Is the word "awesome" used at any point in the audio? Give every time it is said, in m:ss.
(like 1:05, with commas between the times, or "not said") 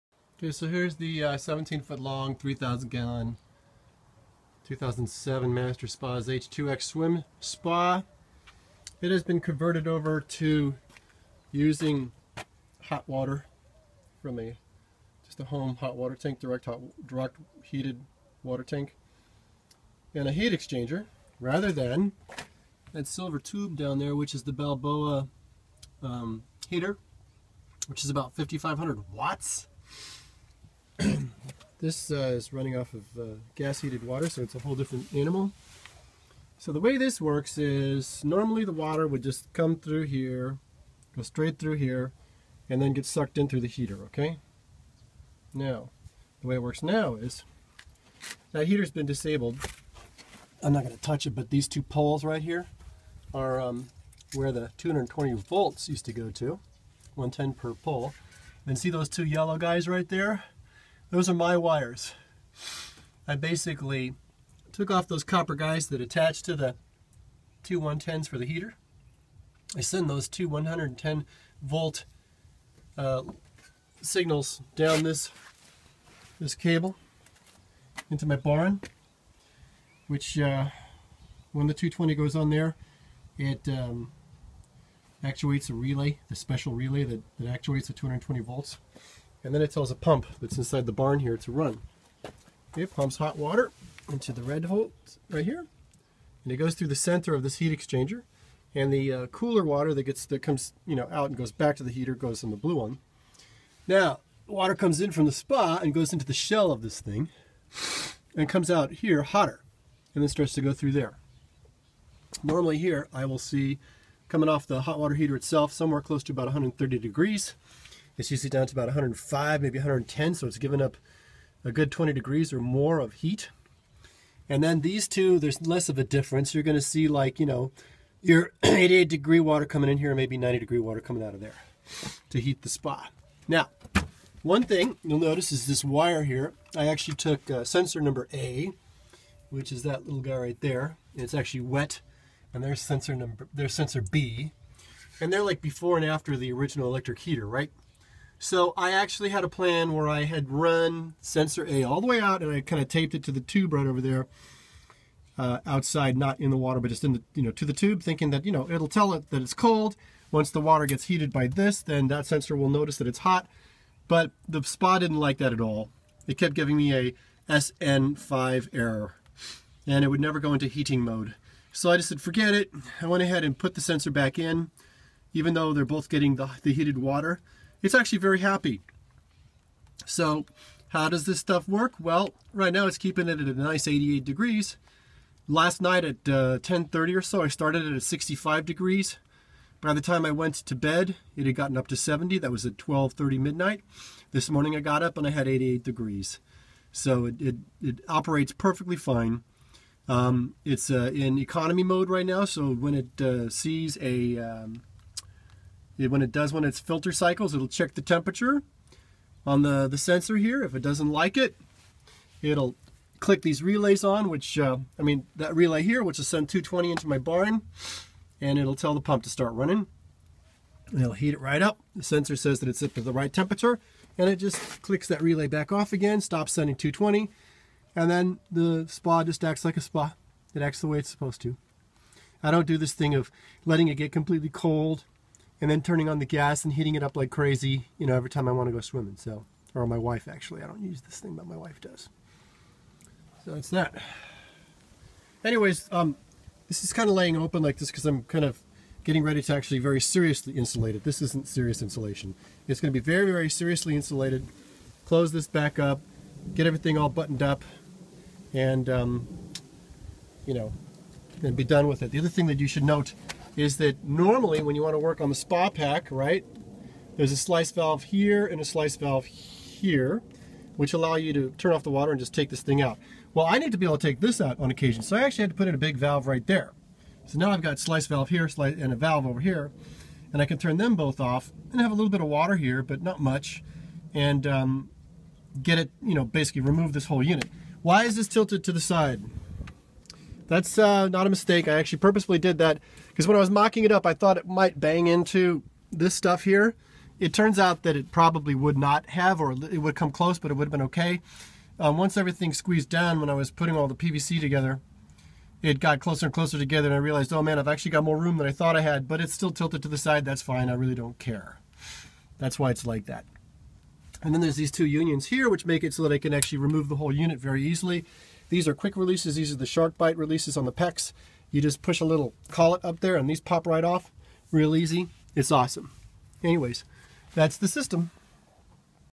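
5:25.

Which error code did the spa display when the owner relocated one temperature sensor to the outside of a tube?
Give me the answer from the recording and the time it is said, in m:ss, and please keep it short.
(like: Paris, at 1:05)
SN5, at 2:47.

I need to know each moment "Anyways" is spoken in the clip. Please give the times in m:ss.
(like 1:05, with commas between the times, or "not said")
4:05, 5:26.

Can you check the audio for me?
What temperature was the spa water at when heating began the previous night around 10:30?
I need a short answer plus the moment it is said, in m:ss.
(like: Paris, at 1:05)
65 degrees, at 3:08.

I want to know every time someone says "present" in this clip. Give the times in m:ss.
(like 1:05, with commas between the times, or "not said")
not said.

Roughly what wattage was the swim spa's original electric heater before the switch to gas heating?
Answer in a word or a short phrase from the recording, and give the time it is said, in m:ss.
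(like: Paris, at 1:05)
5,500 watts, at 0:28.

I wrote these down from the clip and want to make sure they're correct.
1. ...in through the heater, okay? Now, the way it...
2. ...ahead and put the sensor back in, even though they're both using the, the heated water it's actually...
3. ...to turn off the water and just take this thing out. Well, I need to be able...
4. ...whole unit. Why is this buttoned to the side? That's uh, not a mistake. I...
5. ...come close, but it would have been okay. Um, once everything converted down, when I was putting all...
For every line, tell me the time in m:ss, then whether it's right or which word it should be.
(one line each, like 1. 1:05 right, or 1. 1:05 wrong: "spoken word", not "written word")
1. 0:43 right
2. 2:53 wrong: "getting", not "using"
3. 4:31 right
4. 4:47 wrong: "tilted", not "buttoned"
5. 4:59 wrong: "squeezed", not "converted".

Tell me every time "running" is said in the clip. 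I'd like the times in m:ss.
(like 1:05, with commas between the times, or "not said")
0:32, 3:39.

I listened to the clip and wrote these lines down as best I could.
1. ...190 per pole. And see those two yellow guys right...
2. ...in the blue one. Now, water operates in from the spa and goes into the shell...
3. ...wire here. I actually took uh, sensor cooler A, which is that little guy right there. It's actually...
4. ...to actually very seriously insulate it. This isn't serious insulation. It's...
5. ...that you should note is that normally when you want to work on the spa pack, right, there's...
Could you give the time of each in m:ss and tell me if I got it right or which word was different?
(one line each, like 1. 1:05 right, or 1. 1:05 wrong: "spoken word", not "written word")
1. 0:57 wrong: "110", not "190"
2. 1:42 wrong: "comes", not "operates"
3. 2:15 wrong: "number", not "cooler"
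4. 4:09 right
5. 4:22 right.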